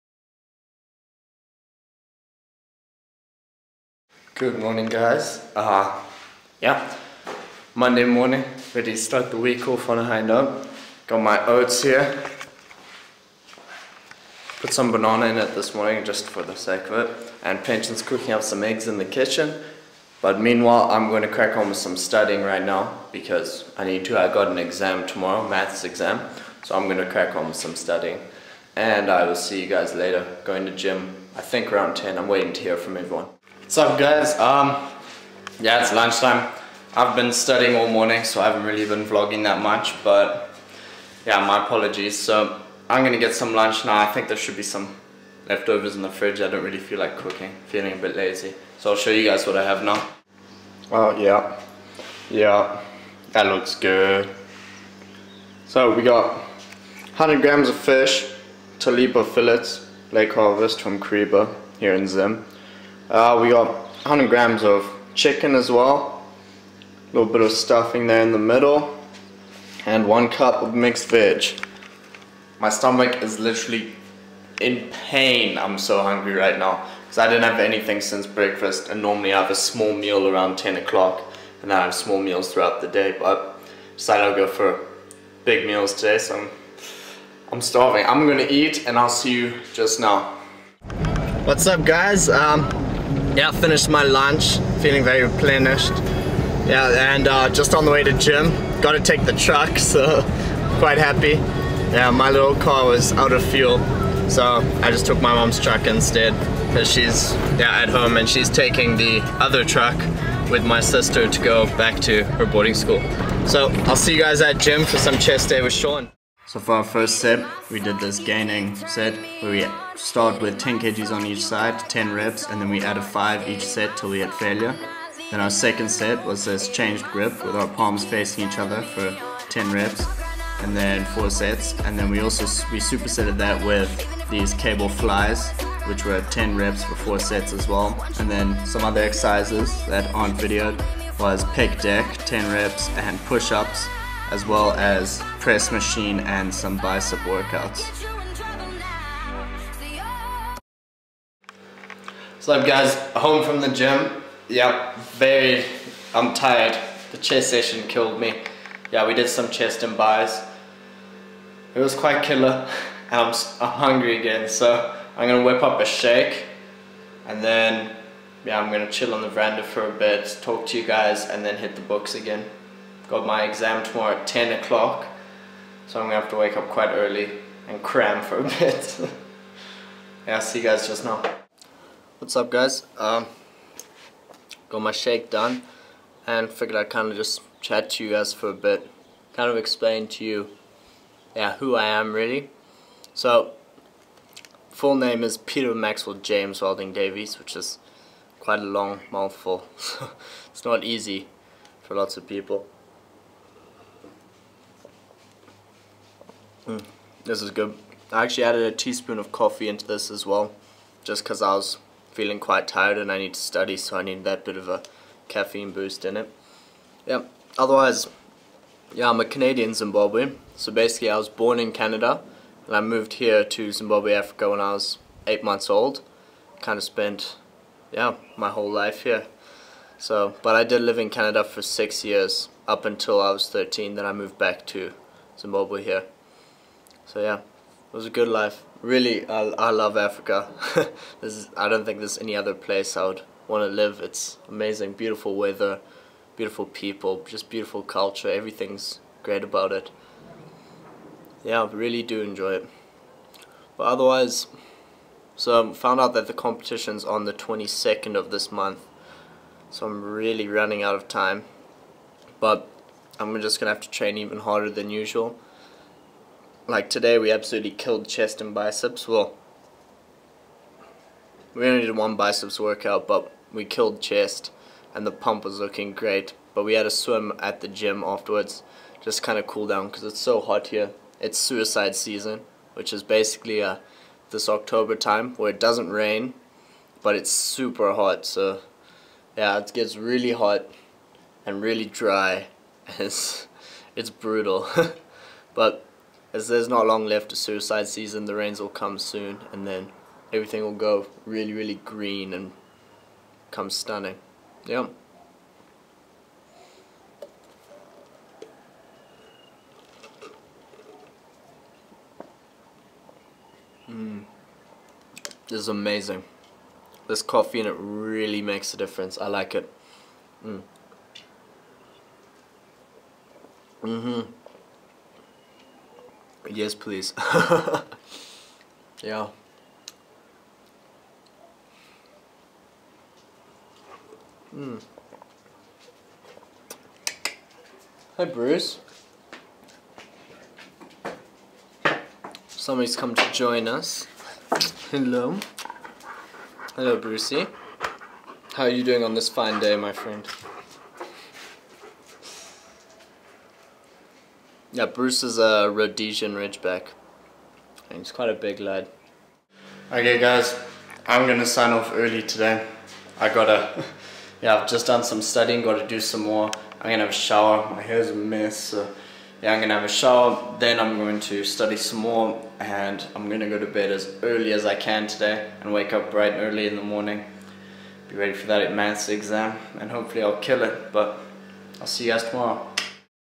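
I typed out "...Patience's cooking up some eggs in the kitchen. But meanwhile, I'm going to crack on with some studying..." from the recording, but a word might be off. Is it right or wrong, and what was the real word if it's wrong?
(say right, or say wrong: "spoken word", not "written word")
right.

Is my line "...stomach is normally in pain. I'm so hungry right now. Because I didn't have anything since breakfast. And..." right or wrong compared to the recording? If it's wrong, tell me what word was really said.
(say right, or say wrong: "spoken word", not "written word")
wrong: "literally", not "normally".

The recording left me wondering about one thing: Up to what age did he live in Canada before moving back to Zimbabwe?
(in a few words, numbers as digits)
13.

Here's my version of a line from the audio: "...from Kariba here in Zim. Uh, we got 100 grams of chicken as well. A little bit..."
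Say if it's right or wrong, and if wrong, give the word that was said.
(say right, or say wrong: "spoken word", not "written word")
right.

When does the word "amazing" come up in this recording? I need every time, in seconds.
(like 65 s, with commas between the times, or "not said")
244 s, 315 s.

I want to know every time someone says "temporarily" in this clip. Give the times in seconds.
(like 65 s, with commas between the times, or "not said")
not said.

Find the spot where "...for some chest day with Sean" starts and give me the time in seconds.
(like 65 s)
114 s.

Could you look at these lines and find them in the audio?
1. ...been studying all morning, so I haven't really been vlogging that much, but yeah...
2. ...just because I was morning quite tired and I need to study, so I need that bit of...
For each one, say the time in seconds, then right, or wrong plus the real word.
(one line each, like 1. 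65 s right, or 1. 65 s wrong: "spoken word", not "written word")
1. 37 s right
2. 211 s wrong: "feeling", not "morning".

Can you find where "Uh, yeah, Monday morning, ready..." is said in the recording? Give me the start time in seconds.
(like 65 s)
5 s.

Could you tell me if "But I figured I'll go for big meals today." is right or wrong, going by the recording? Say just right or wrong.
wrong.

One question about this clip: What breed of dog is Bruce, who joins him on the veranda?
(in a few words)
Rhodesian Ridgeback.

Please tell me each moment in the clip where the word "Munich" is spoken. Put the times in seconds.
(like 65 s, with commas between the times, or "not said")
not said.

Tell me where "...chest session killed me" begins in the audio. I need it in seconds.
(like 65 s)
157 s.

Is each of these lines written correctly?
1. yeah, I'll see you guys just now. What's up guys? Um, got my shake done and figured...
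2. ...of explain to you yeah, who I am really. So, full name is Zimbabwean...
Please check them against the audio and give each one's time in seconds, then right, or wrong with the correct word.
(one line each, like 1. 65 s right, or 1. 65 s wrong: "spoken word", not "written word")
1. 180 s right
2. 189 s wrong: "Peter", not "Zimbabwean".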